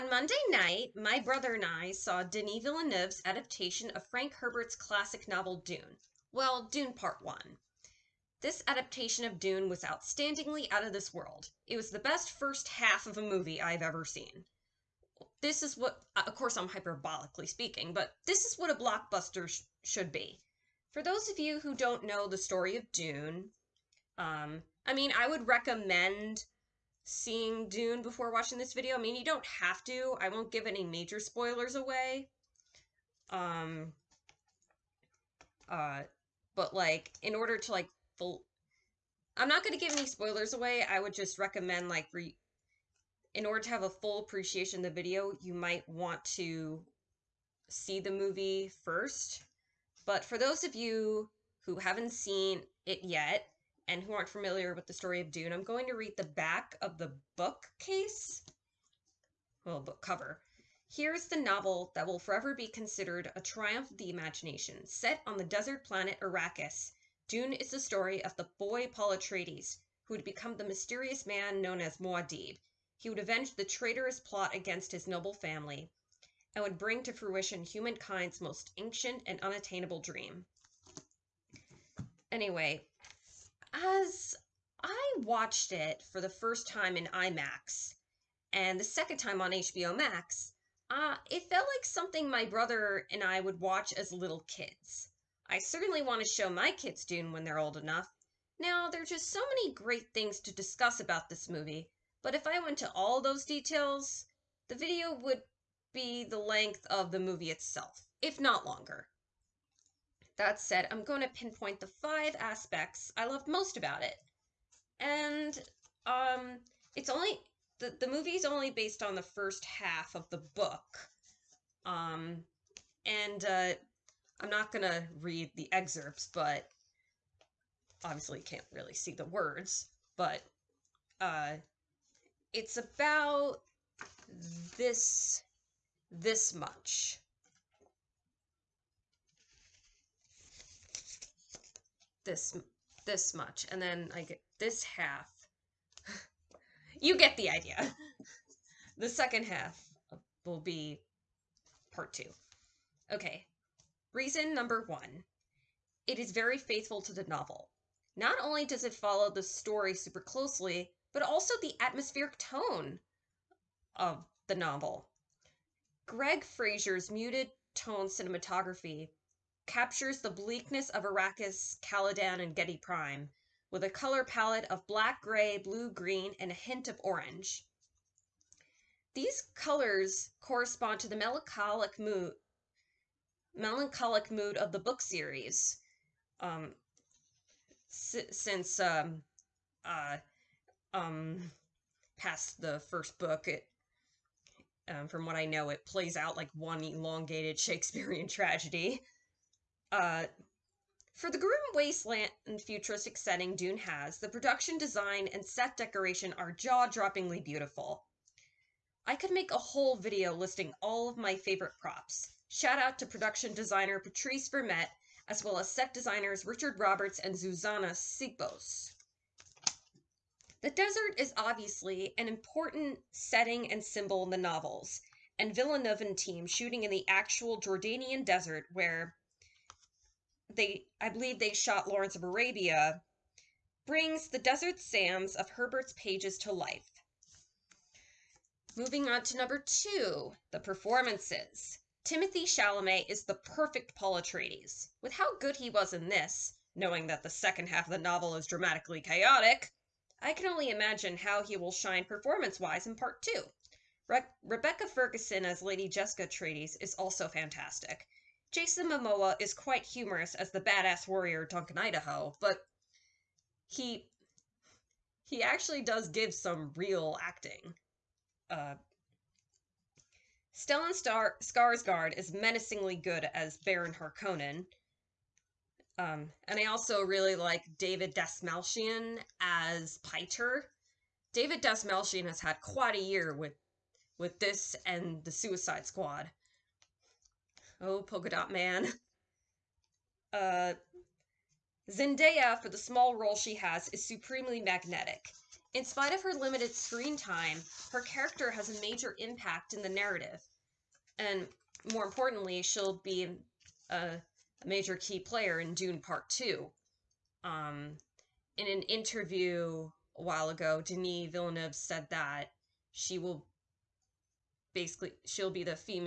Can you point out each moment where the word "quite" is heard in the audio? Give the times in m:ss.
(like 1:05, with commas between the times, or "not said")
4:19, 4:42.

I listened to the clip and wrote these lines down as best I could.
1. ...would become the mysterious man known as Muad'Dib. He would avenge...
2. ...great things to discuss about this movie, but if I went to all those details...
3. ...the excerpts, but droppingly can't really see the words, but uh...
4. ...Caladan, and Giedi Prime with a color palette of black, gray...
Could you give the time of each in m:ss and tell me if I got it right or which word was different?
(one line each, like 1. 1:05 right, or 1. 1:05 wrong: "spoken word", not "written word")
1. 1:10 right
2. 1:39 right
3. 2:05 wrong: "obviously", not "droppingly"
4. 2:51 right.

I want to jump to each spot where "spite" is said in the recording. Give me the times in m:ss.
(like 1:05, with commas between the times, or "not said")
4:55.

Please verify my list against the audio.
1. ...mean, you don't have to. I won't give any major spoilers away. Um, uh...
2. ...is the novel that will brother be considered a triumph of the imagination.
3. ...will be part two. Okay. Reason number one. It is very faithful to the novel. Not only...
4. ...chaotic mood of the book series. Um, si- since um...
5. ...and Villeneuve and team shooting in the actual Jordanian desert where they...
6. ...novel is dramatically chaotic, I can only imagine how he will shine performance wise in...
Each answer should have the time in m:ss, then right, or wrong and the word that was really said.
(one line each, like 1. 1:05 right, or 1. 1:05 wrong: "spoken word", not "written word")
1. 0:28 right
2. 1:01 wrong: "forever", not "brother"
3. 2:30 right
4. 3:03 wrong: "melancholic", not "chaotic"
5. 3:45 right
6. 4:07 right.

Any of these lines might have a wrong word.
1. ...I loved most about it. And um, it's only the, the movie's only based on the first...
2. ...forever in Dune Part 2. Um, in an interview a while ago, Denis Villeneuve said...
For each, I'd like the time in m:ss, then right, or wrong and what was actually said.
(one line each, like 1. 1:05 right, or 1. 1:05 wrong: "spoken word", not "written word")
1. 1:53 right
2. 5:05 wrong: "player", not "forever".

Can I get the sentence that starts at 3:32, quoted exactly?
Shout out to production designer Patrice Vermette, as well as set designers Richard Roberts and Zsuzsanna Sipos.